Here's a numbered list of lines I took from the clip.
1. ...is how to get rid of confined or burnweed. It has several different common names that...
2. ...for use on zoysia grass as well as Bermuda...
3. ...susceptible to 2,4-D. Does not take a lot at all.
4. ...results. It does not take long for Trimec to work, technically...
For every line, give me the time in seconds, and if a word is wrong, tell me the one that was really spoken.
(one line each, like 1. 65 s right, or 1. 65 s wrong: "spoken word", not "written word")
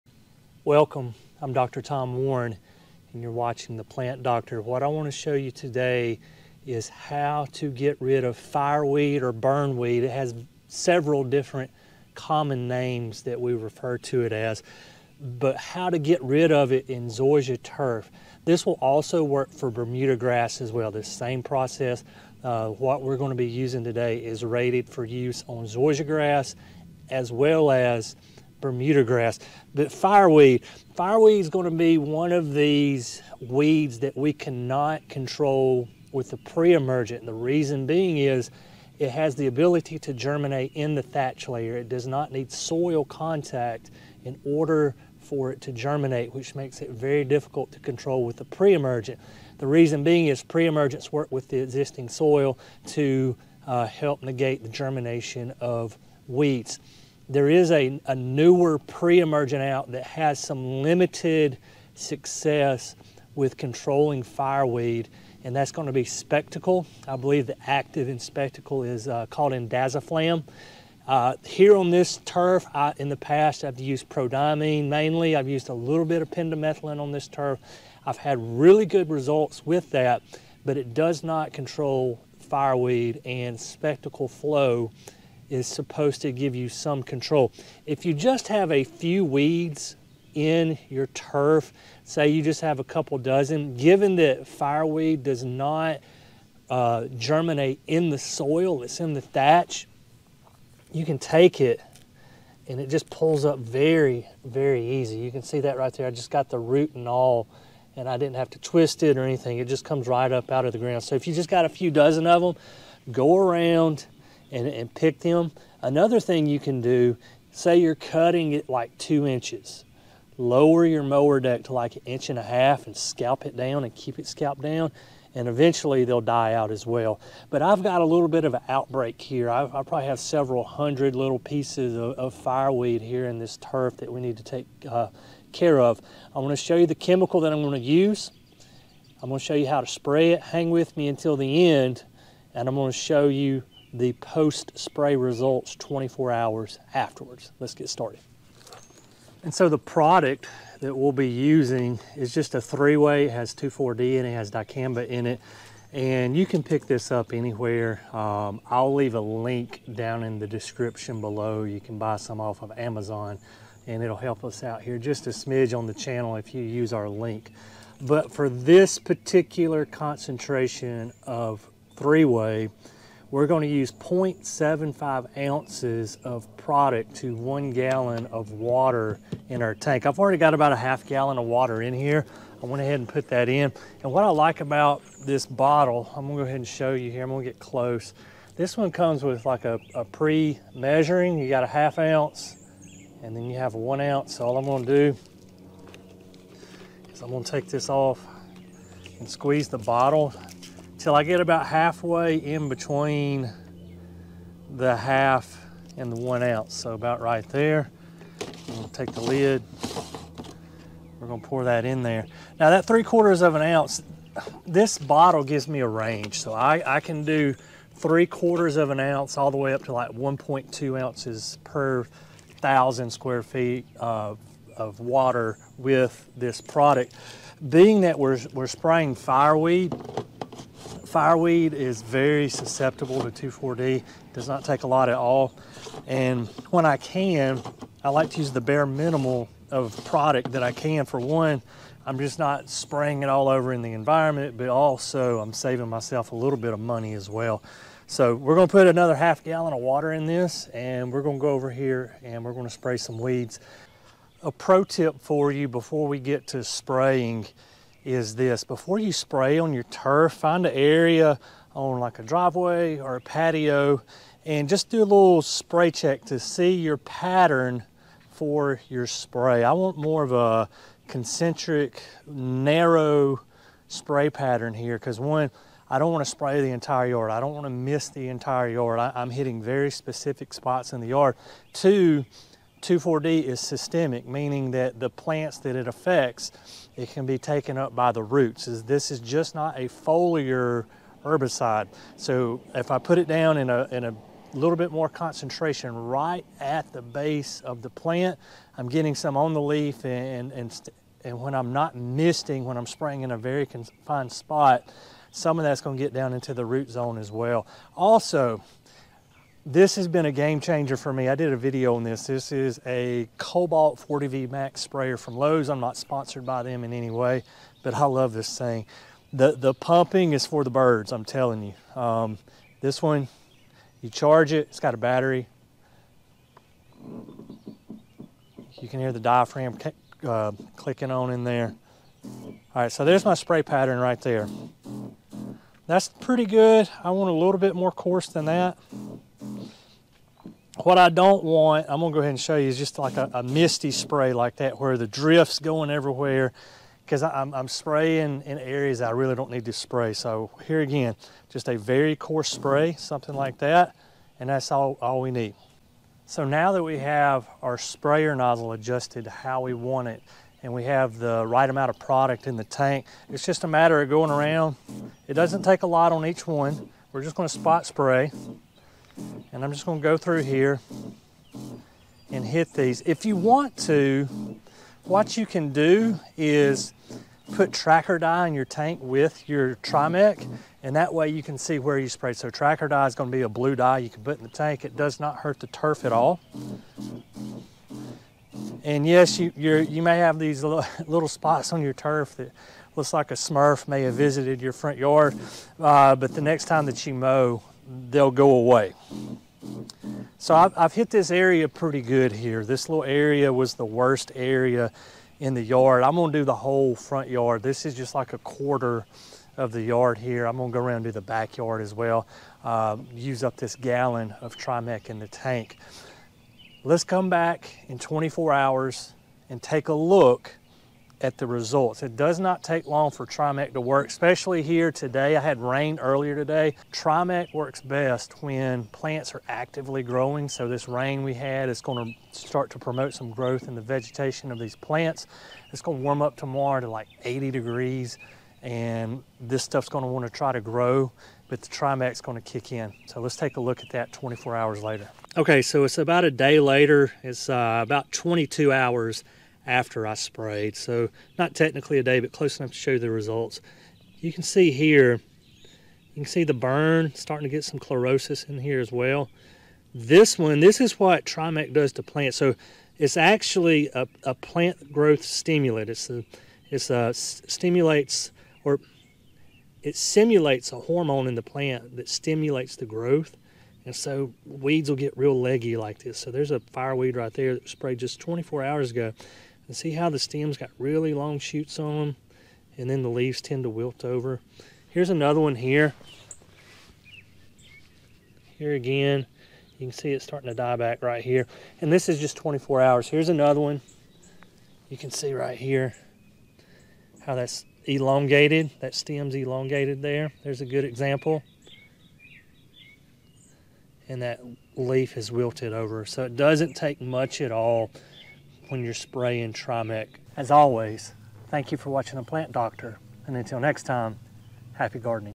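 1. 6 s wrong: "fireweed", not "confined"
2. 24 s right
3. 232 s right
4. 421 s wrong: "especially", not "technically".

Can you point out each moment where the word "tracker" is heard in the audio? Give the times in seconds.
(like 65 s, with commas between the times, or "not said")
377 s, 382 s.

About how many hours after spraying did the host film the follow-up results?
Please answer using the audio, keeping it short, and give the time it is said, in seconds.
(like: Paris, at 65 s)
22, at 448 s.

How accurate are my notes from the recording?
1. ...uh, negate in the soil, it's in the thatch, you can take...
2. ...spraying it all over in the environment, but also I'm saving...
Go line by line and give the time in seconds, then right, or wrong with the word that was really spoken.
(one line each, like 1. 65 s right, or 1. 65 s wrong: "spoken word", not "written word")
1. 96 s wrong: "germinate", not "negate"
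2. 242 s right.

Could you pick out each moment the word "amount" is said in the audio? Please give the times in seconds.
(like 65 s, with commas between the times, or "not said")
361 s.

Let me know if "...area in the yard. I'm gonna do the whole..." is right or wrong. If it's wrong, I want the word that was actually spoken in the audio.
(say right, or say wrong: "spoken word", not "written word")
right.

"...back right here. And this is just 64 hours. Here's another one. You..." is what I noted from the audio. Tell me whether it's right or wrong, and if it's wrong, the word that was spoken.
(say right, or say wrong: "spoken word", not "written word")
wrong: "24", not "64".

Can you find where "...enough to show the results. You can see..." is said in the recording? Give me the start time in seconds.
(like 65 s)
452 s.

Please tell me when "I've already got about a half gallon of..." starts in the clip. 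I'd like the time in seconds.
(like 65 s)
180 s.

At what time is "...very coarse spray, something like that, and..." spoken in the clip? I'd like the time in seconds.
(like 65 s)
351 s.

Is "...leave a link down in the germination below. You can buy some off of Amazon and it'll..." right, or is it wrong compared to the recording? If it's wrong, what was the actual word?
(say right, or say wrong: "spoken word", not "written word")
wrong: "description", not "germination".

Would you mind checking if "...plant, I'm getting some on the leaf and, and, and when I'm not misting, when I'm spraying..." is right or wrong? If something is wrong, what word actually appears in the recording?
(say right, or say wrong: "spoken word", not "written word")
right.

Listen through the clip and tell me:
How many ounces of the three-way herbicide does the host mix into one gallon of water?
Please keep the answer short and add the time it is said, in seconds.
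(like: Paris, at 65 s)
0.75 ounces, at 173 s.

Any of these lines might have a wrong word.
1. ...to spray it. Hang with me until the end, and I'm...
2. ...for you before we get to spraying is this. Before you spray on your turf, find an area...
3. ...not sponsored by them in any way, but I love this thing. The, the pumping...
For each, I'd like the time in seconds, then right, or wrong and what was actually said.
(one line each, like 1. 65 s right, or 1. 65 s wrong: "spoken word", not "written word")
1. 139 s right
2. 255 s right
3. 315 s right.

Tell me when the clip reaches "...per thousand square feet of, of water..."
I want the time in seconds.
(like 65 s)
221 s.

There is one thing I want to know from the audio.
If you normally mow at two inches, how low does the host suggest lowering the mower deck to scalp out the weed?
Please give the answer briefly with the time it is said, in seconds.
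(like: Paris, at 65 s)
1.5 inches, at 121 s.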